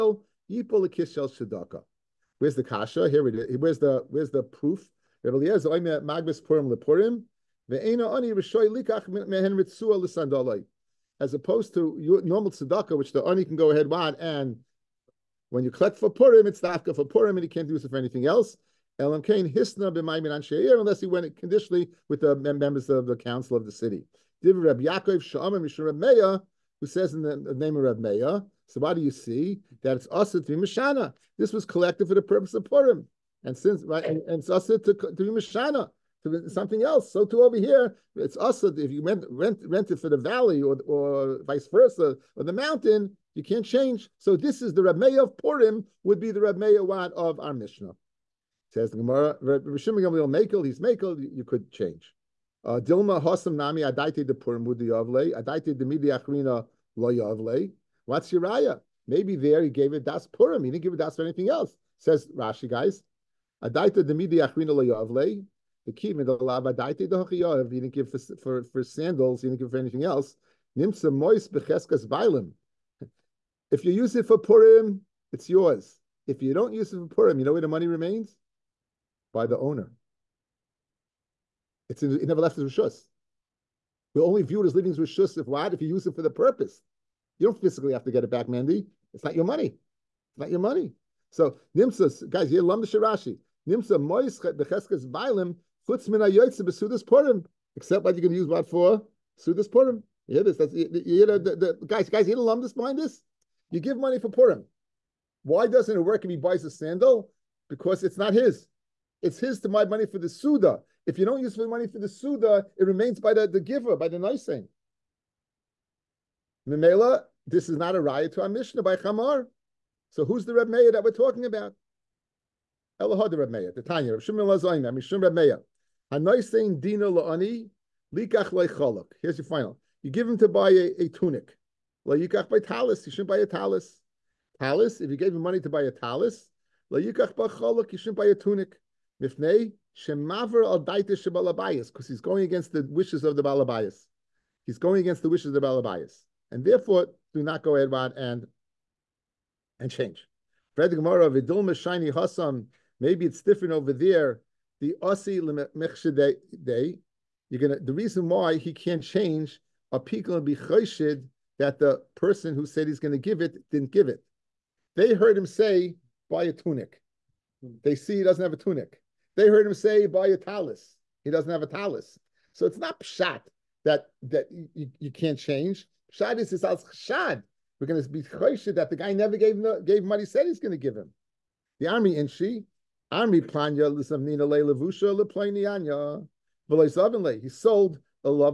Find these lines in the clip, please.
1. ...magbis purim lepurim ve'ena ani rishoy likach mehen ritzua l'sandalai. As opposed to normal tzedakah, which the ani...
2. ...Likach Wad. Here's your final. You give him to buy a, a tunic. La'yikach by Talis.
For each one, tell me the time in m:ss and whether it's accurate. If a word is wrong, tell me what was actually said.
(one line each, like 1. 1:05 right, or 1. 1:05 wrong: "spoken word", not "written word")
1. 0:06 right
2. 2:08 wrong: "Leicholok", not "Wad".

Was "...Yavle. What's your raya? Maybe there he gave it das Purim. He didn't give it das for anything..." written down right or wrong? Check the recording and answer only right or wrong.
right.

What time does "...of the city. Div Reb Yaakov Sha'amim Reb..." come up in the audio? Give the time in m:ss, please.
0:23.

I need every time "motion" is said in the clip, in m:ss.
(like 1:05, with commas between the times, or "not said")
not said.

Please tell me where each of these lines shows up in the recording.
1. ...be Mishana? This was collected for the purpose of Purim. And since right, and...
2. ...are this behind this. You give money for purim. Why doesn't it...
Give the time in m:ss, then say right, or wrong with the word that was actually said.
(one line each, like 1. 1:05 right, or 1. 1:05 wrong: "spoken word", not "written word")
1. 0:30 right
2. 1:42 right.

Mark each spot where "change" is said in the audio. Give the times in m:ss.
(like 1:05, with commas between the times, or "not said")
0:43, 0:51, 2:29, 2:39, 2:55.